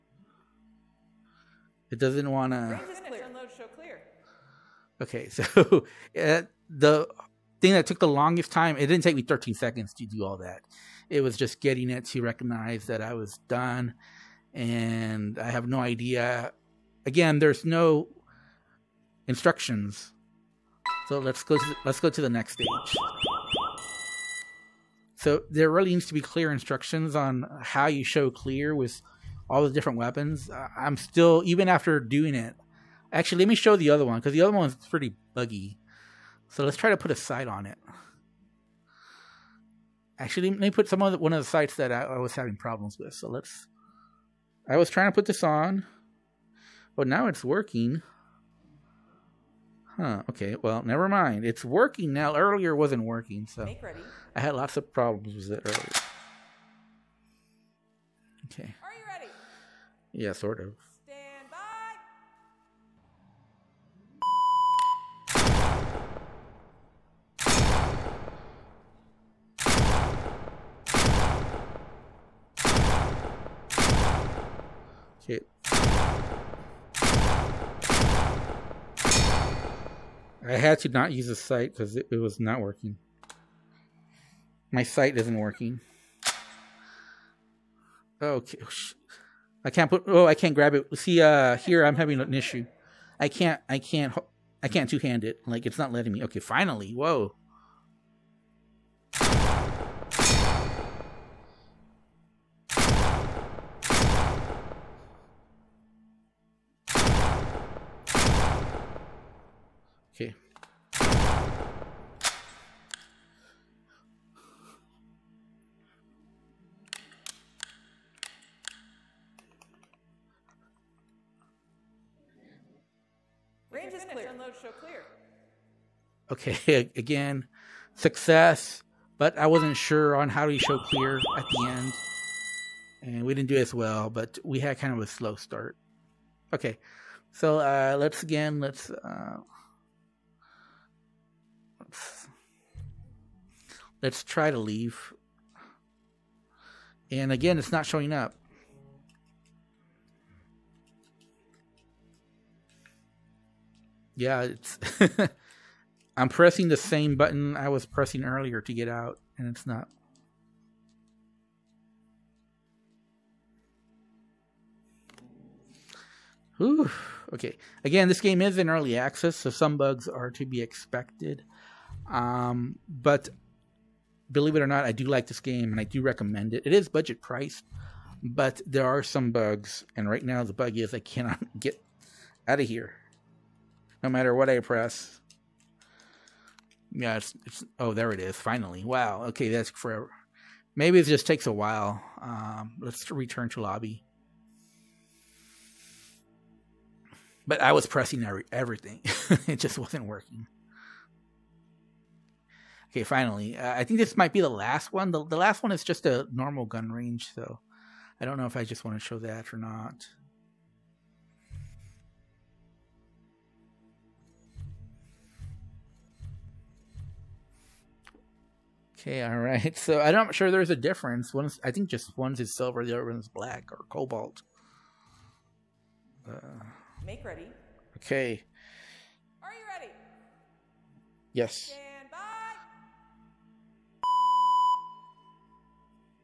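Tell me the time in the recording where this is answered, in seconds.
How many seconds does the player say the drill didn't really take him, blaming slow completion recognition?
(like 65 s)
9 s.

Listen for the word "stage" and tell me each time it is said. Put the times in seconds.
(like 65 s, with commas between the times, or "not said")
22 s.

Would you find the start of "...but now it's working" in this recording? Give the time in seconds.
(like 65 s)
46 s.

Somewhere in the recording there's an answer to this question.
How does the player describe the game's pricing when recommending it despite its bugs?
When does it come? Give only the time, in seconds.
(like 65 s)
176 s.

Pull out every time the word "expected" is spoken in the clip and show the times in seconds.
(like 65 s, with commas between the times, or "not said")
170 s.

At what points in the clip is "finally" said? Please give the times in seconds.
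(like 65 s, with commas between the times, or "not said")
96 s, 188 s, 203 s.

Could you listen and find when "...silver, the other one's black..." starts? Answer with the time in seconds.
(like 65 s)
222 s.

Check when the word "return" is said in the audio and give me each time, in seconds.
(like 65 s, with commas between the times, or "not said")
193 s.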